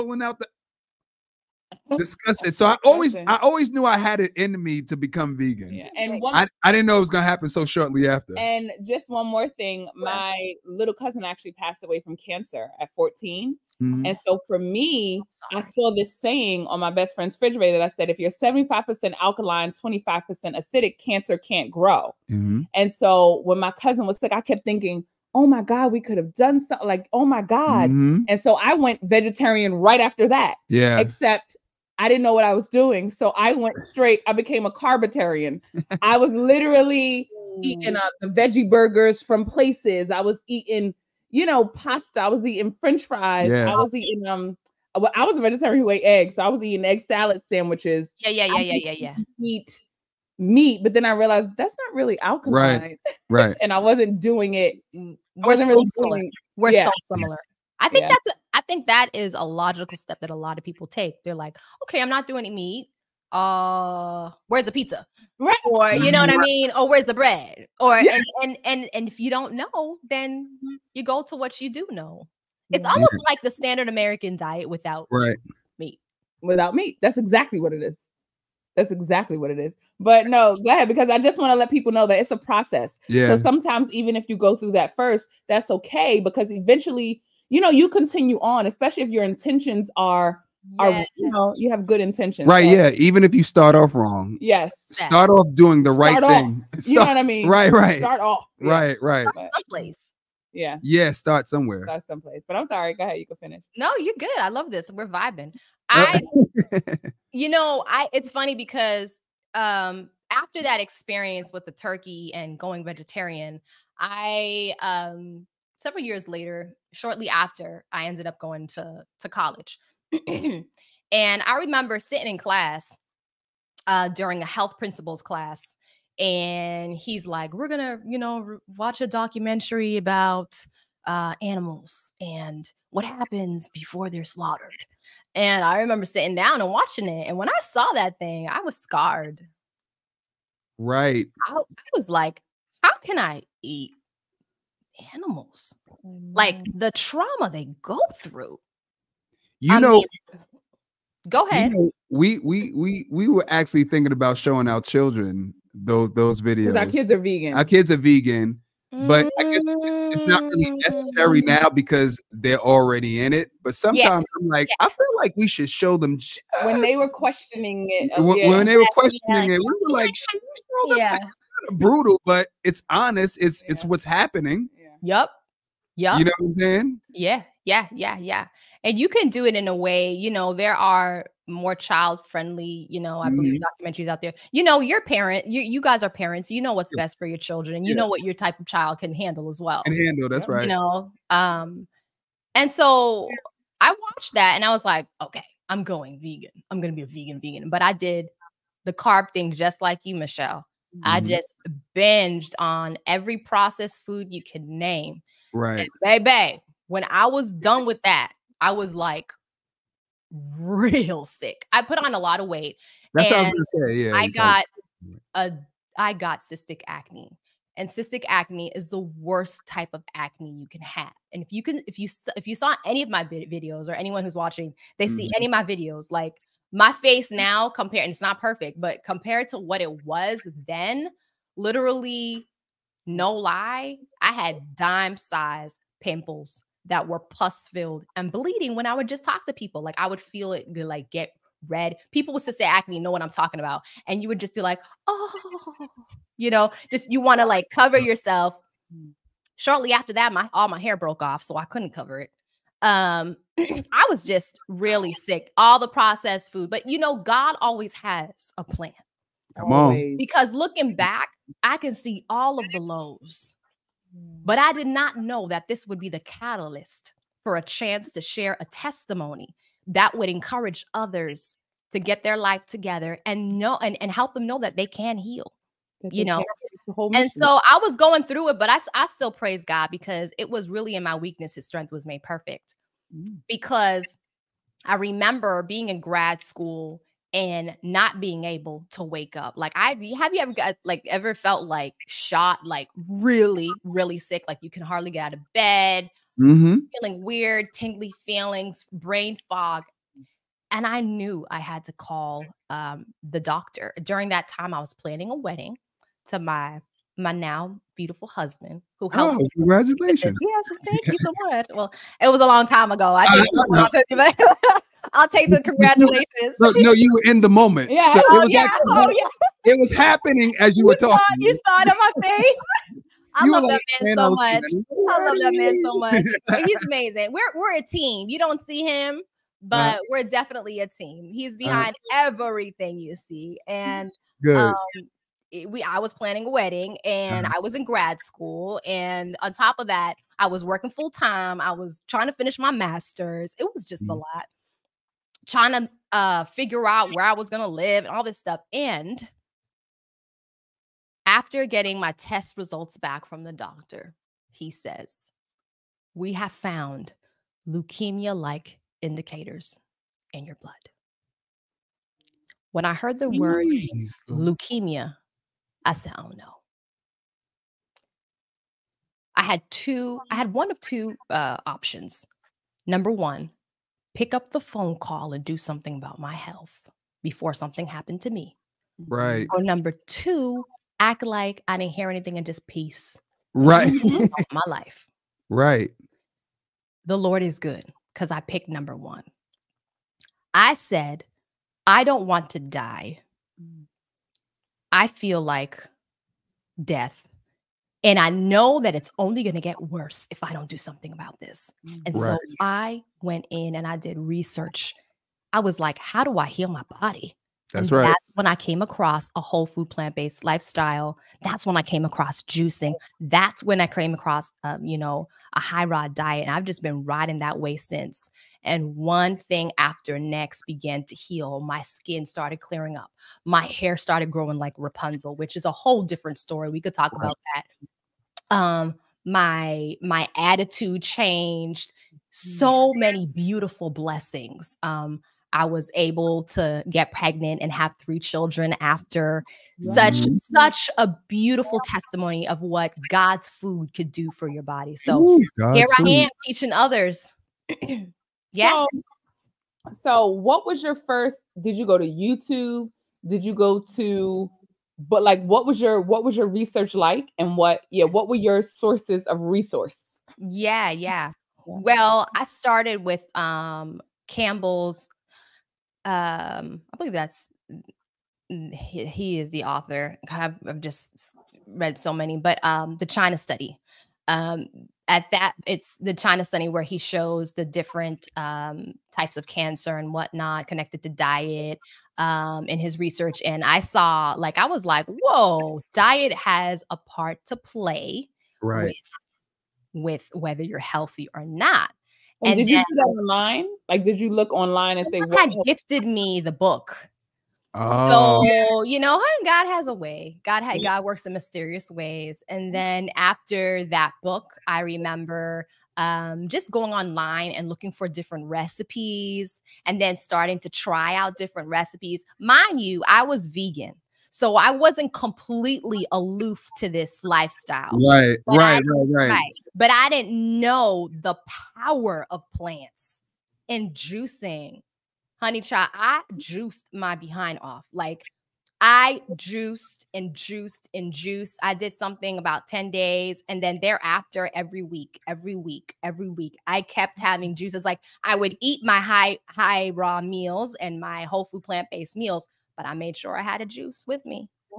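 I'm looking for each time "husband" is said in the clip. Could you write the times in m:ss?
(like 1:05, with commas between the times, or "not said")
5:08.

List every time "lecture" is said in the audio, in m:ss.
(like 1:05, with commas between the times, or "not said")
not said.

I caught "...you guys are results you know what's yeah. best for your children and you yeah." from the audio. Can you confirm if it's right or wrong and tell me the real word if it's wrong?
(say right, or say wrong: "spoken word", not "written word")
wrong: "parents", not "results".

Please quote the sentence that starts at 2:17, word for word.
And when I saw that thing, I was scarred.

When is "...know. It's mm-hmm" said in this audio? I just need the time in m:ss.
1:11.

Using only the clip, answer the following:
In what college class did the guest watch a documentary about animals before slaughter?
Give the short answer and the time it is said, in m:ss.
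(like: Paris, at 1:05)
health principles class, at 2:04.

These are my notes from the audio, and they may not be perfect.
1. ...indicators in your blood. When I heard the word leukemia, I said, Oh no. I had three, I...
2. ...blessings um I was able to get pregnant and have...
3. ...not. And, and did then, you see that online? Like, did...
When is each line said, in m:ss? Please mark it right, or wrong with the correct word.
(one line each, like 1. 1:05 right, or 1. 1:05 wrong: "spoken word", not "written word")
1. 5:59 wrong: "two", not "three"
2. 7:13 right
3. 8:11 right.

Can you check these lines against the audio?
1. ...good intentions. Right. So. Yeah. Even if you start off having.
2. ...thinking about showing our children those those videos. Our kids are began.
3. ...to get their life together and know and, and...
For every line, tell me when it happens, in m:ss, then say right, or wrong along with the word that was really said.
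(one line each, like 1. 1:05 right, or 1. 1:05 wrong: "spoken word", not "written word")
1. 1:31 wrong: "wrong", not "having"
2. 2:33 wrong: "vegan", not "began"
3. 4:31 right.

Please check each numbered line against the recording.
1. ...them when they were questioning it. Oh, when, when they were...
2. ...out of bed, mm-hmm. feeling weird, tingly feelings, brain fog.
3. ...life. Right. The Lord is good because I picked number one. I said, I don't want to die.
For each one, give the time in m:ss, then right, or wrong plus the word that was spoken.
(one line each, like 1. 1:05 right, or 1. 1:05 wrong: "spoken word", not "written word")
1. 2:45 right
2. 4:55 right
3. 6:24 right.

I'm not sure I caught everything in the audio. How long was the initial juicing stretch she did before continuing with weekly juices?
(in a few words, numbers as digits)
10 days.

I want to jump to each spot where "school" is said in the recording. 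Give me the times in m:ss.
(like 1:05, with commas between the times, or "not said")
4:46, 5:38.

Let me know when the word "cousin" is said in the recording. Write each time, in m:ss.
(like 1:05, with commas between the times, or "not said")
0:10, 0:23.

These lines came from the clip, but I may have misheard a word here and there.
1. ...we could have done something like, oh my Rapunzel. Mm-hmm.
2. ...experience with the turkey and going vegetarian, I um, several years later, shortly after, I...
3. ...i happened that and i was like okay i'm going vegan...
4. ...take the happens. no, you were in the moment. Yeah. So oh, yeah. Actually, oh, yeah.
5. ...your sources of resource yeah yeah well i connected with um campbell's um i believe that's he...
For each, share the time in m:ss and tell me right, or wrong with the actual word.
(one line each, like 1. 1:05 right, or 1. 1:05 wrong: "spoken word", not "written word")
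1. 0:25 wrong: "God", not "Rapunzel"
2. 1:50 right
3. 3:13 wrong: "watched", not "happened"
4. 5:15 wrong: "congratulations", not "happens"
5. 7:38 wrong: "started", not "connected".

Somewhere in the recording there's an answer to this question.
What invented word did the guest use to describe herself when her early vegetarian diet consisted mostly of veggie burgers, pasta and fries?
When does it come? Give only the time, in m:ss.
0:34.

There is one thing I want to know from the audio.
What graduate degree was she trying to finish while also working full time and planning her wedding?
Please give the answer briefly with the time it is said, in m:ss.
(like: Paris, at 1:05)
masters, at 5:42.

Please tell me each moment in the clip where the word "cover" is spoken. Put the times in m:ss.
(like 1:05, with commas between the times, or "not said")
4:07, 4:11.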